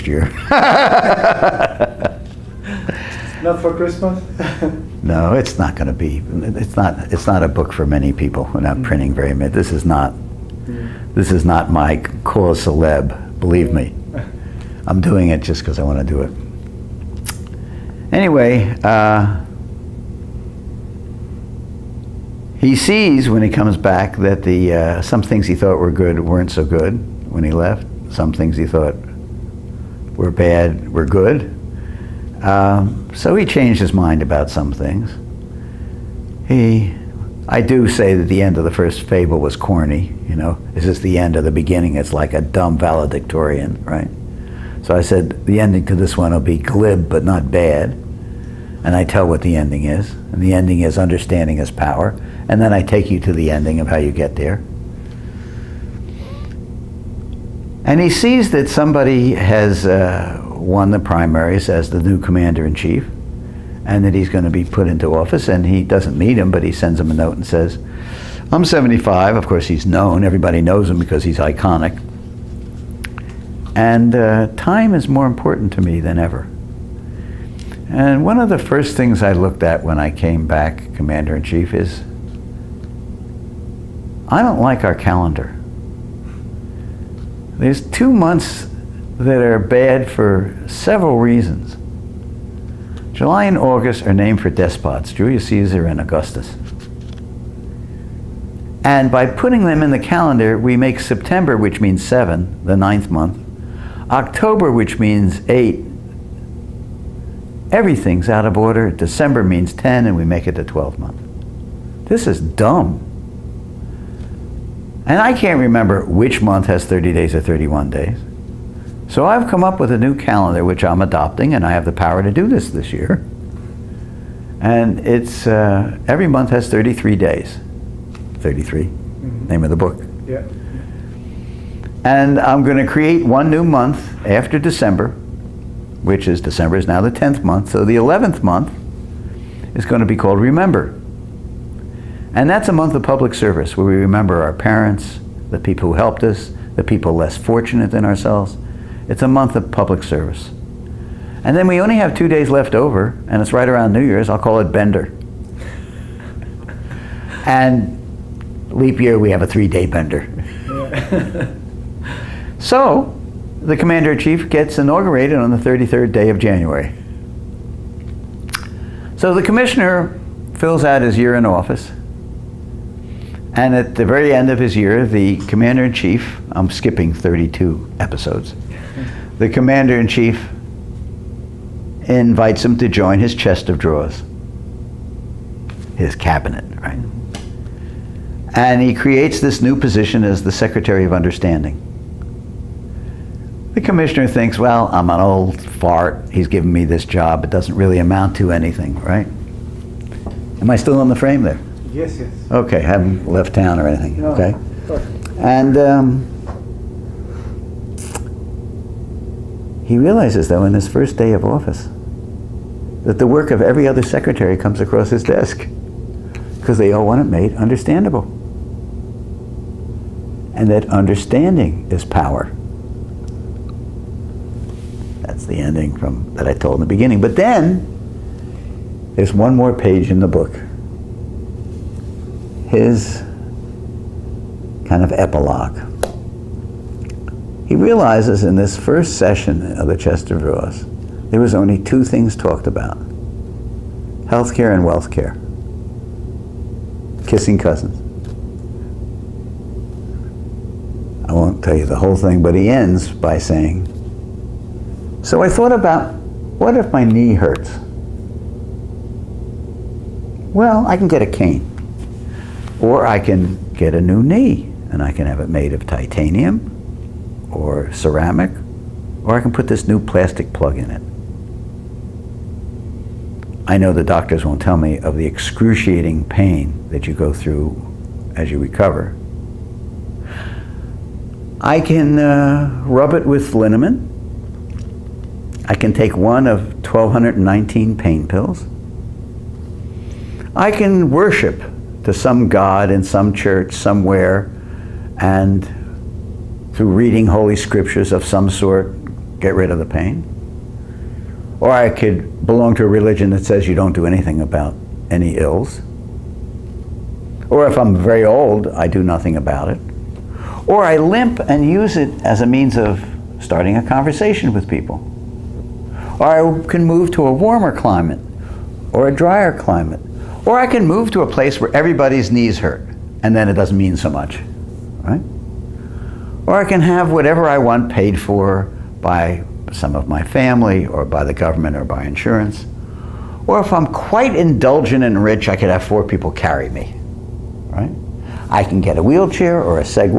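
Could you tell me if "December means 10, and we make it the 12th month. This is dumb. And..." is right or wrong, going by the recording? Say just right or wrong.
right.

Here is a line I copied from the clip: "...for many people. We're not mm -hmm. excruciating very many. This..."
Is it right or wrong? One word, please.
wrong.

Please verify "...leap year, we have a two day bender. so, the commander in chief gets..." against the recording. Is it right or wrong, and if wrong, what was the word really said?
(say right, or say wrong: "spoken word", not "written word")
wrong: "three", not "two".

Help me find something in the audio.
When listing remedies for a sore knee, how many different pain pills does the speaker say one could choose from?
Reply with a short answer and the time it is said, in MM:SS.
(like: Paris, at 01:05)
1,219, at 04:46.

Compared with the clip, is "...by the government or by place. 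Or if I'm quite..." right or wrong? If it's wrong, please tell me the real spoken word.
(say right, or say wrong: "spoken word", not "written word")
wrong: "insurance", not "place".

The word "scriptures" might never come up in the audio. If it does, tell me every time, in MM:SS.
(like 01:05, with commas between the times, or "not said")
04:57.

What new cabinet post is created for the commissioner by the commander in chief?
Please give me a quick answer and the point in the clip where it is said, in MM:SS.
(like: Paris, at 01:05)
Secretary of Understanding, at 03:10.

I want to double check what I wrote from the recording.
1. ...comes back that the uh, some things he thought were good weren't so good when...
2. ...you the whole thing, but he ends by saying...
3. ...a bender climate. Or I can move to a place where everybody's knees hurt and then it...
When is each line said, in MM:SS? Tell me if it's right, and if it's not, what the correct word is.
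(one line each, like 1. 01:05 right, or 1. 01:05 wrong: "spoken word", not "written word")
1. 00:23 right
2. 04:11 right
3. 05:19 wrong: "drier", not "bender".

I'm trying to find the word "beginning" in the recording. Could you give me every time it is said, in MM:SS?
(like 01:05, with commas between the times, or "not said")
00:41, 03:46.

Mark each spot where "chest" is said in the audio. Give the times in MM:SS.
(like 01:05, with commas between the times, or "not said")
03:03, 03:59.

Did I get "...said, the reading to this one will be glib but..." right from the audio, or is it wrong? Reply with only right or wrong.
wrong.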